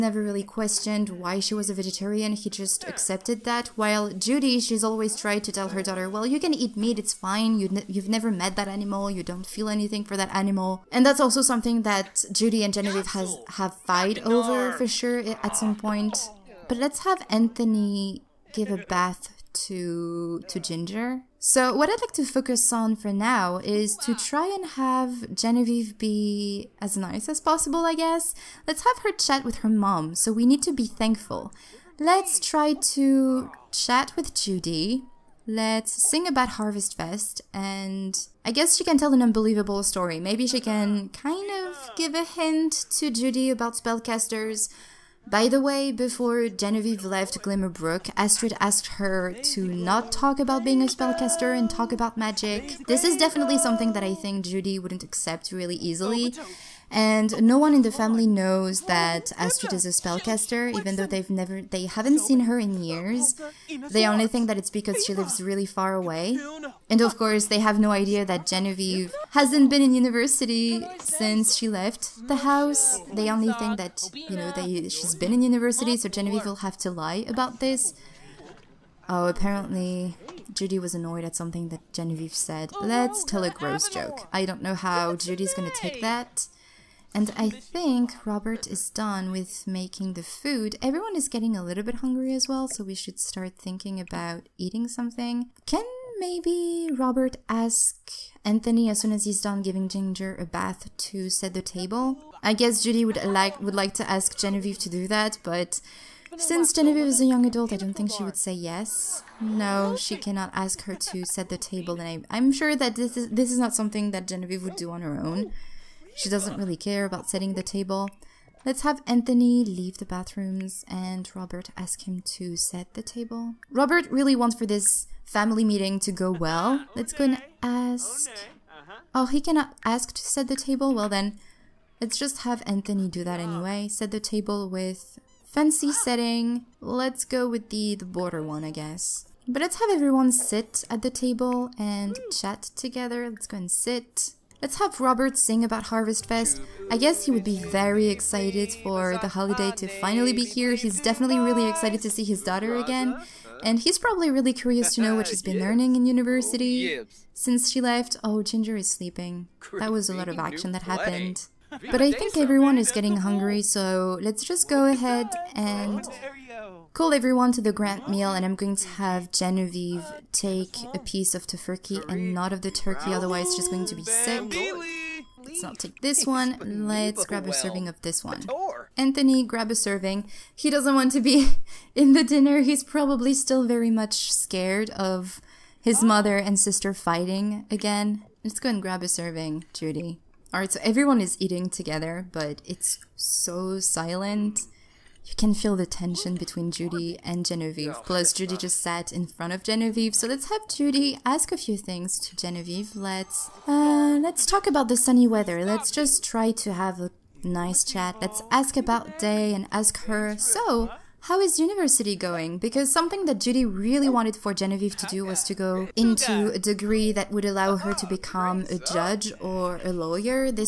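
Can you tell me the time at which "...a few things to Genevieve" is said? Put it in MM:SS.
03:21.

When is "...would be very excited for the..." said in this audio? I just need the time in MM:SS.
02:27.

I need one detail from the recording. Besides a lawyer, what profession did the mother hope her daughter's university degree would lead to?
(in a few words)
Judge.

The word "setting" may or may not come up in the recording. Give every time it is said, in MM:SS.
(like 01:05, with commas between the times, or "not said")
01:57, 02:16.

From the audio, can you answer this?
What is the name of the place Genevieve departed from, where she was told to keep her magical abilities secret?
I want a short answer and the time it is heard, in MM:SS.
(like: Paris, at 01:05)
Glimmerbrook, at 00:47.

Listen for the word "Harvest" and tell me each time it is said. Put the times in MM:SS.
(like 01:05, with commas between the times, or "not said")
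00:36, 02:25.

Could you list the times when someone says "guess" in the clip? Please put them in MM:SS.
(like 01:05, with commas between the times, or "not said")
00:27, 00:38, 01:42, 02:18, 02:26.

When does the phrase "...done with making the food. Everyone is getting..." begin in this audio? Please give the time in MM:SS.
01:28.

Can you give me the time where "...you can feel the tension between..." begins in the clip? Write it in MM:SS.
03:15.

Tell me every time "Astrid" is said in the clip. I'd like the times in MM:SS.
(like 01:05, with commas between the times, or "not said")
00:48, 00:59.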